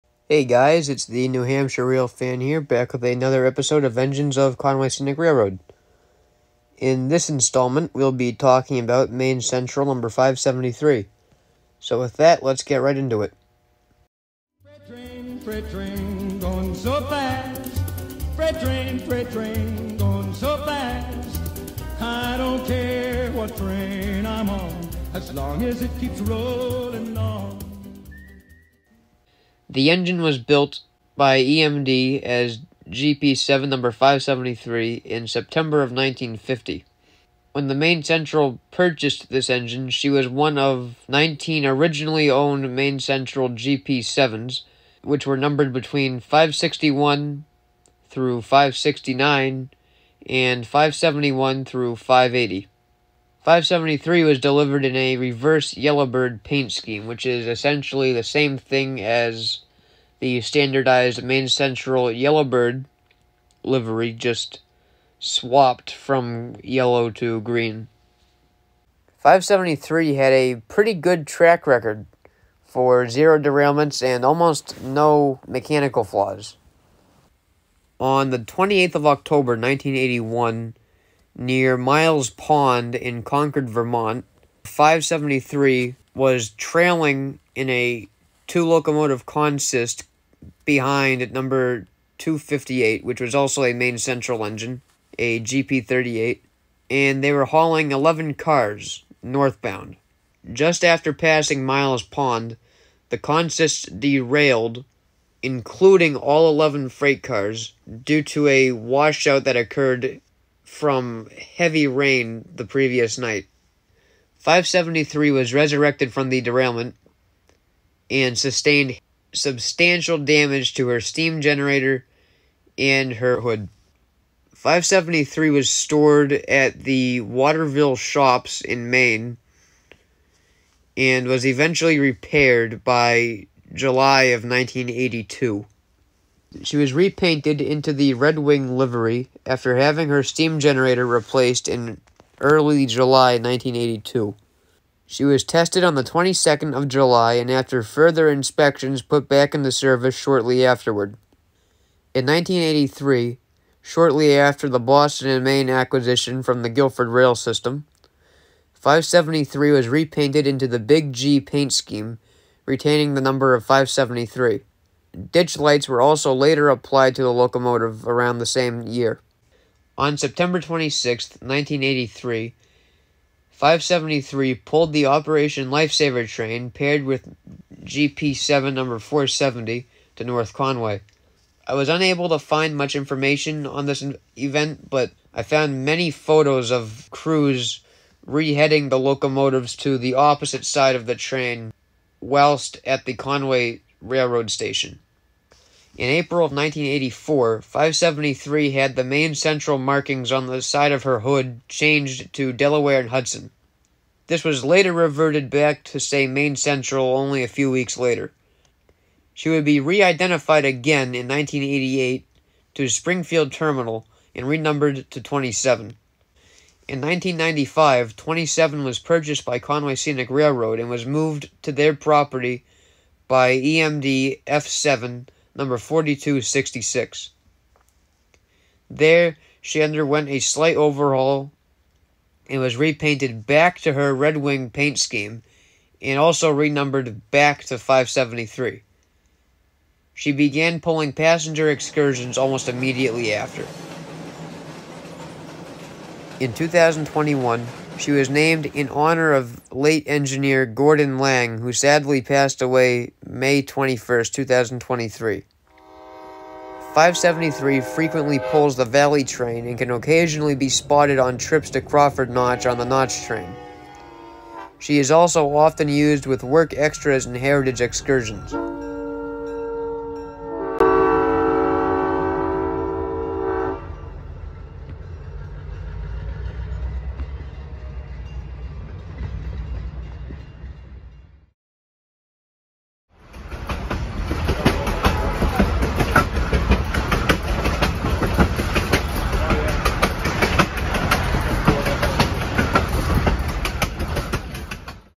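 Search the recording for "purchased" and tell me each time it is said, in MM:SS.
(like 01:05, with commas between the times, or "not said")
00:38, 03:38.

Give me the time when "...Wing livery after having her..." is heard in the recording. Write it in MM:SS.
02:18.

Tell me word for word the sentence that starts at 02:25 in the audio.
She was tested on the 22nd of July and after further inspections put back into service shortly afterward.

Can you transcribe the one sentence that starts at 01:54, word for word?
573 was resurrected from the derailment and sustained substantial damage to her steam generator and her hood.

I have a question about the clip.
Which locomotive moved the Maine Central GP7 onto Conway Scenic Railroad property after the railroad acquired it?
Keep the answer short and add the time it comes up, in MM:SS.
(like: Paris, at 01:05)
F7 4266, at 03:44.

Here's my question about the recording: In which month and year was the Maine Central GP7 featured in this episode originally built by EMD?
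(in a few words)
September 1950.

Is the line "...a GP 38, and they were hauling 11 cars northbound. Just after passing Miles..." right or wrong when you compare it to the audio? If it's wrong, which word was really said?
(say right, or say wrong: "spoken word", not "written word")
right.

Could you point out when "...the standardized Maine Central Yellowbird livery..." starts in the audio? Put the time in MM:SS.
01:00.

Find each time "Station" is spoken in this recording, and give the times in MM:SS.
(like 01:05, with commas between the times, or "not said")
03:14.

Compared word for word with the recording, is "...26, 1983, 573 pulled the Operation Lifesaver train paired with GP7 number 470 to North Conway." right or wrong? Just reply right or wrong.
right.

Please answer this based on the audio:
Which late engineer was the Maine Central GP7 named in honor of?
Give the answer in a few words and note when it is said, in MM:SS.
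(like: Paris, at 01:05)
Gordon Lang, at 04:10.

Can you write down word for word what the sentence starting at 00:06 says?
In this installment, we'll be talking about Maine Central number 573.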